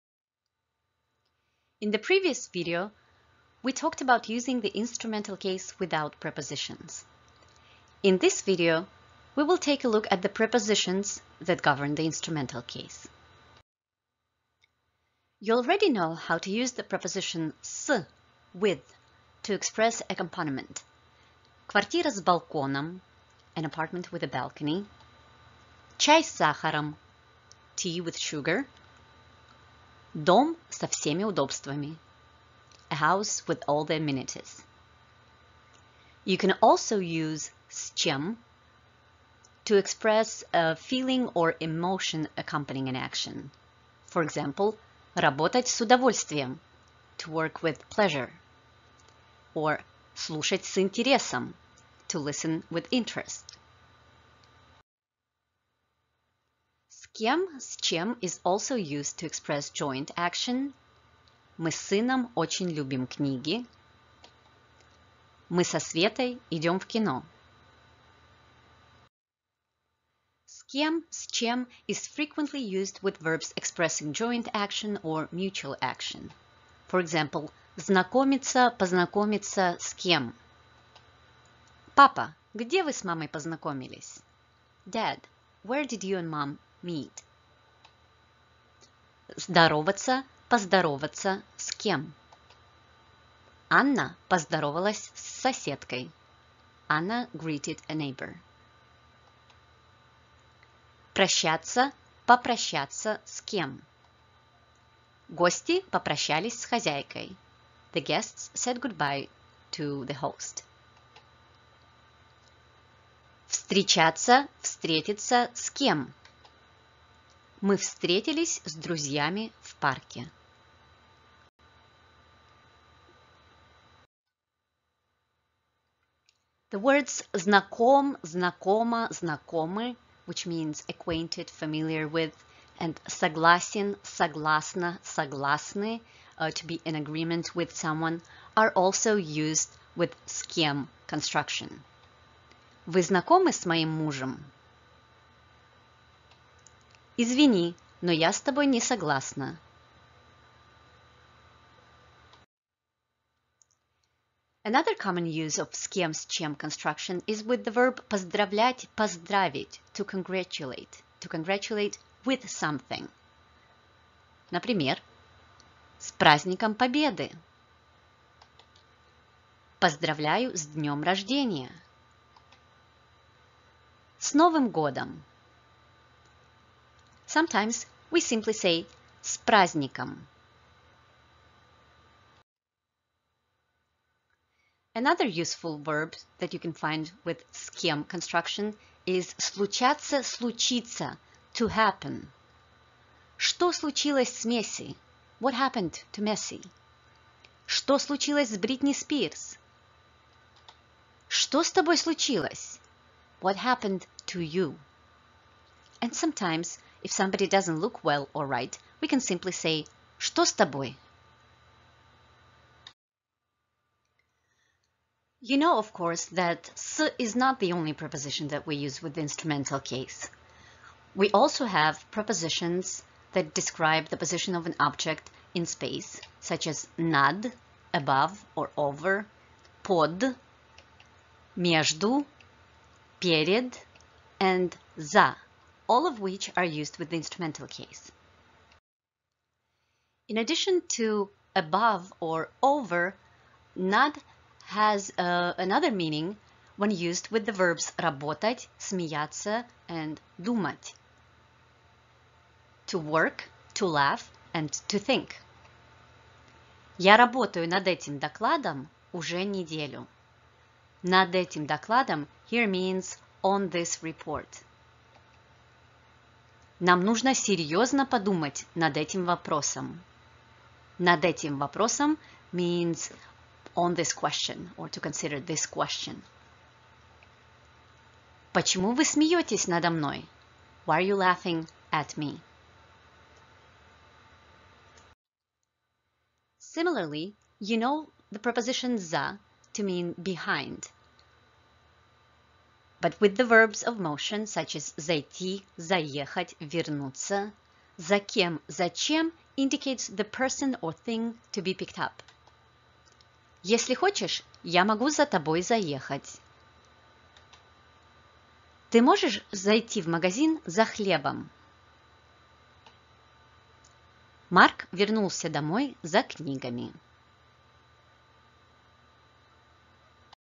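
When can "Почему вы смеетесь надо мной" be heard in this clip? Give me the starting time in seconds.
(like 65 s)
278 s.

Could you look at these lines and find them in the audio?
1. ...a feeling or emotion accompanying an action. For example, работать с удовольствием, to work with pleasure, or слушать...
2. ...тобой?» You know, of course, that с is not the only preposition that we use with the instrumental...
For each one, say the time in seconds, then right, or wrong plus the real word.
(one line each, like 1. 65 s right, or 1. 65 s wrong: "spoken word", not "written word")
1. 40 s right
2. 210 s right.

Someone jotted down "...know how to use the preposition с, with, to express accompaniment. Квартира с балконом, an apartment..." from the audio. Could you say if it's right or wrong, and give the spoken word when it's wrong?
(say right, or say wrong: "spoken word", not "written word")
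right.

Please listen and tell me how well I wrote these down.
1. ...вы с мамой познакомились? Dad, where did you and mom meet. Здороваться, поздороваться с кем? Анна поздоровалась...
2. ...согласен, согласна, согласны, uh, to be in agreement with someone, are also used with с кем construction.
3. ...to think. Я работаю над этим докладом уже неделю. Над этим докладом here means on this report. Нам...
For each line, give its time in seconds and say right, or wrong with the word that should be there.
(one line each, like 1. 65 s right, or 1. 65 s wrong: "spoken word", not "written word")
1. 82 s right
2. 133 s right
3. 254 s right.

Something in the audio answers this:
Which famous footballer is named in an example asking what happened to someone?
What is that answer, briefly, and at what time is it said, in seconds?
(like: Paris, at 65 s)
Messi, at 193 s.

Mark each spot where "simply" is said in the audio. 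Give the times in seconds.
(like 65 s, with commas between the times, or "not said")
178 s, 209 s.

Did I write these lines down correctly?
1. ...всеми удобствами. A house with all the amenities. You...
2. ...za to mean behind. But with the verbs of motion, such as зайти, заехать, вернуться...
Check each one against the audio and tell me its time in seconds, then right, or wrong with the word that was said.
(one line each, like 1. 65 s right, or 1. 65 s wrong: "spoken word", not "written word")
1. 30 s right
2. 288 s right.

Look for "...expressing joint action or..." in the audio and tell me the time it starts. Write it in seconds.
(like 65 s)
73 s.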